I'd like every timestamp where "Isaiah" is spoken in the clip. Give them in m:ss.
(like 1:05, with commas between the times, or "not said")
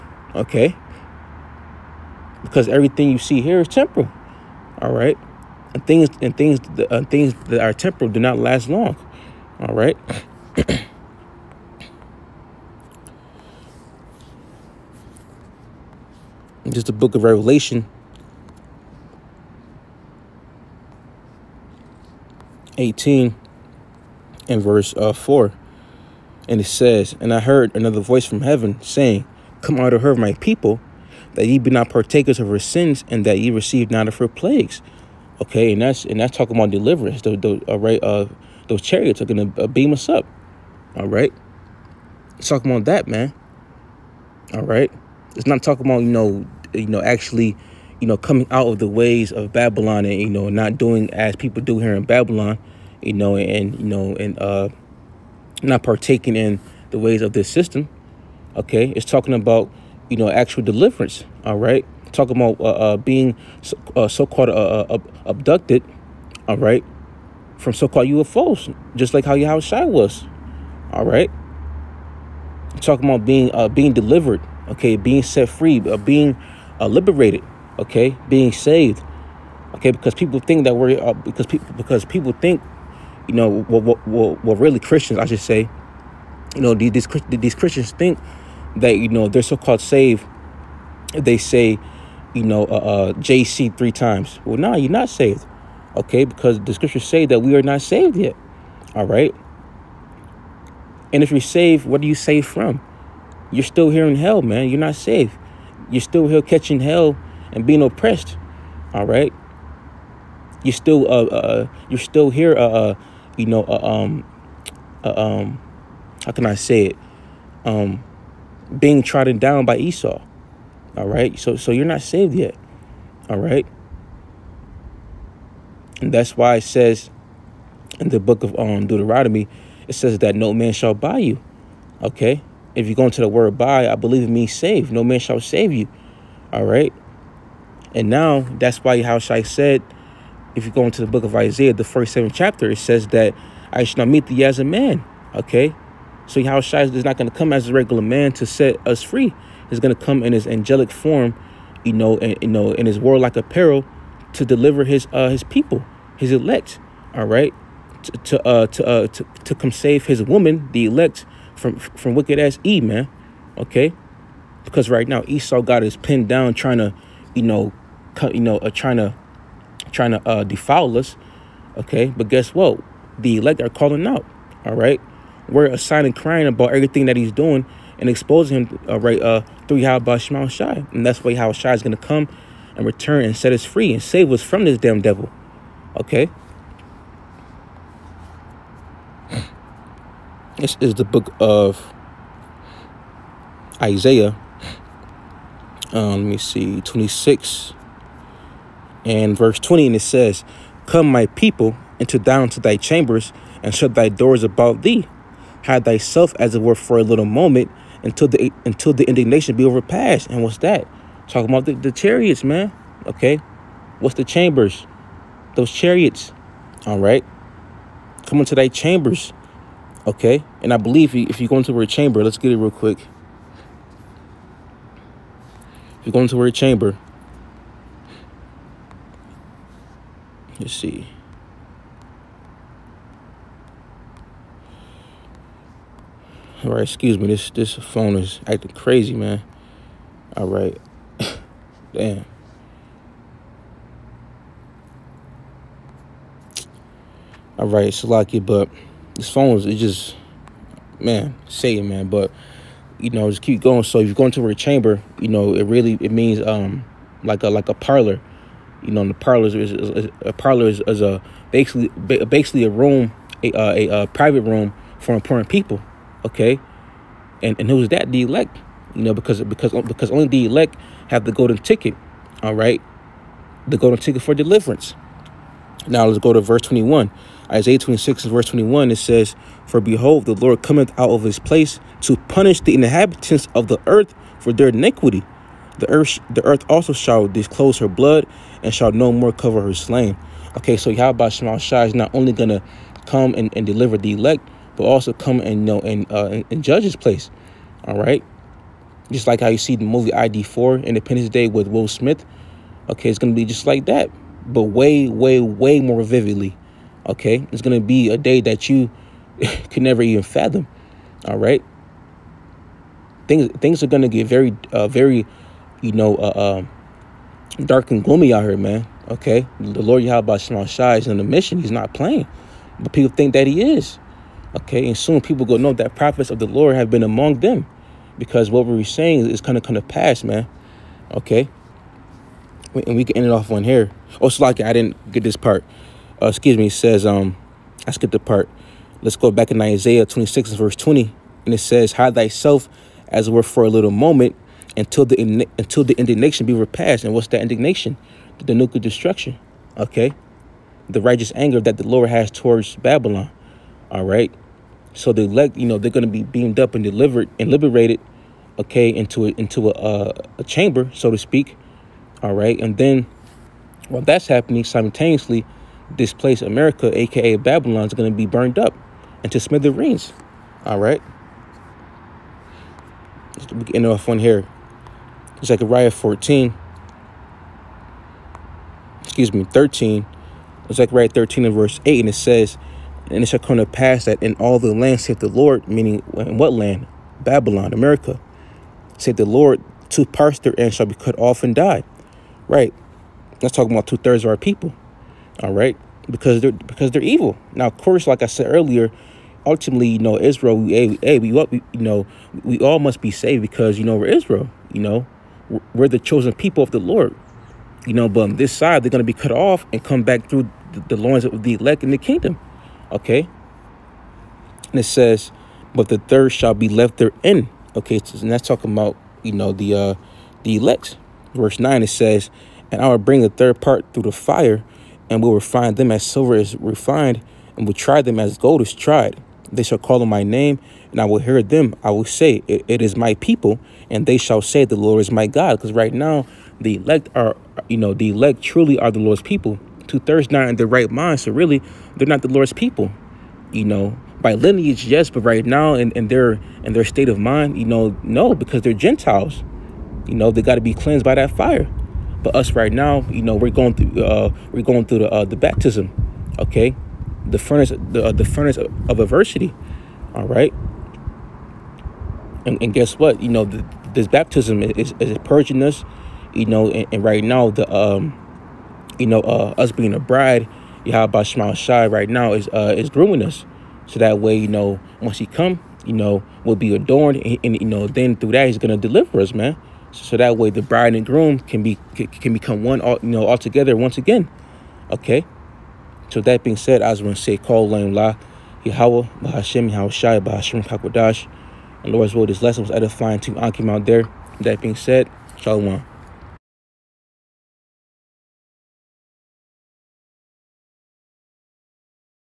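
2:21, 3:13, 4:37, 5:39.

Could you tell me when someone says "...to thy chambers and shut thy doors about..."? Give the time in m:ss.
3:22.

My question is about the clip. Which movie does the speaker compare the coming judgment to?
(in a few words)
Independence Day.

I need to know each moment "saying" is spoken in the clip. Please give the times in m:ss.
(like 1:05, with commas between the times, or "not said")
0:28, 5:28.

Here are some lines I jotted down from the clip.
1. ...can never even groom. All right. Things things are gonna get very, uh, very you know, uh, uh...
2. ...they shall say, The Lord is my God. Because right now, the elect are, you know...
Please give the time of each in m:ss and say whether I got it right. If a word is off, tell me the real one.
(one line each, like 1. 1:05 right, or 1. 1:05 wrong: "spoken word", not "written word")
1. 5:09 wrong: "fathom", not "groom"
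2. 7:14 right.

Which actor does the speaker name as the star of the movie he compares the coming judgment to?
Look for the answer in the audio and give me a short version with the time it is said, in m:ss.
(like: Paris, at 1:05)
Will Smith, at 5:01.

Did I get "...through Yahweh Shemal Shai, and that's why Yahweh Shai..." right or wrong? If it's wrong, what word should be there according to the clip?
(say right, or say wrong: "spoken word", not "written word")
right.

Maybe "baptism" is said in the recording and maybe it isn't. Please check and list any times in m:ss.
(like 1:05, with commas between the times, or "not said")
7:35, 7:44.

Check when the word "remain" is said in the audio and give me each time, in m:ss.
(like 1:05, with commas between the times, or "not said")
not said.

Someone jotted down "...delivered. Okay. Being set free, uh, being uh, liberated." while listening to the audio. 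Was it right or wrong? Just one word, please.
right.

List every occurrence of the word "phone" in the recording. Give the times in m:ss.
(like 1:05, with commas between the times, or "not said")
3:57, 4:09.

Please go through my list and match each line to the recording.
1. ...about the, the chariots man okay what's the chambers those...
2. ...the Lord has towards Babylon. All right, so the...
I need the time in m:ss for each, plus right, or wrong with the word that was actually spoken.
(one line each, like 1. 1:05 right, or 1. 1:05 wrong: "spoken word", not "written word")
1. 3:31 right
2. 5:51 right.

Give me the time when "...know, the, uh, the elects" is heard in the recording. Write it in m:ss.
6:59.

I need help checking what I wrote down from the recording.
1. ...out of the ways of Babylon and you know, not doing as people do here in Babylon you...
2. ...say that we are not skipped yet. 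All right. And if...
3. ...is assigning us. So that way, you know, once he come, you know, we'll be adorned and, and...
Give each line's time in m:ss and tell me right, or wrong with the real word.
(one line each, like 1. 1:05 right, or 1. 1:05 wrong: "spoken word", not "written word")
1. 0:48 right
2. 1:37 wrong: "saved", not "skipped"
3. 7:52 wrong: "grooming", not "assigning".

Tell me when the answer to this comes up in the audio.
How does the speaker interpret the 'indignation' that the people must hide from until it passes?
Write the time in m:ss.
5:48.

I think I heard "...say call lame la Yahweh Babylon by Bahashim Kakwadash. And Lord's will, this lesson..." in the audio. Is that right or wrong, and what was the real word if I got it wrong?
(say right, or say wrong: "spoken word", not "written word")
wrong: "Bahashim", not "Babylon".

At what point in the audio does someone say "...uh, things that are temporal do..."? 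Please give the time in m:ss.
0:06.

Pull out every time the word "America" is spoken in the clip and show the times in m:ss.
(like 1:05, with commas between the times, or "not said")
6:06, 6:27.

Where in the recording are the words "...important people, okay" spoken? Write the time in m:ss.
4:25.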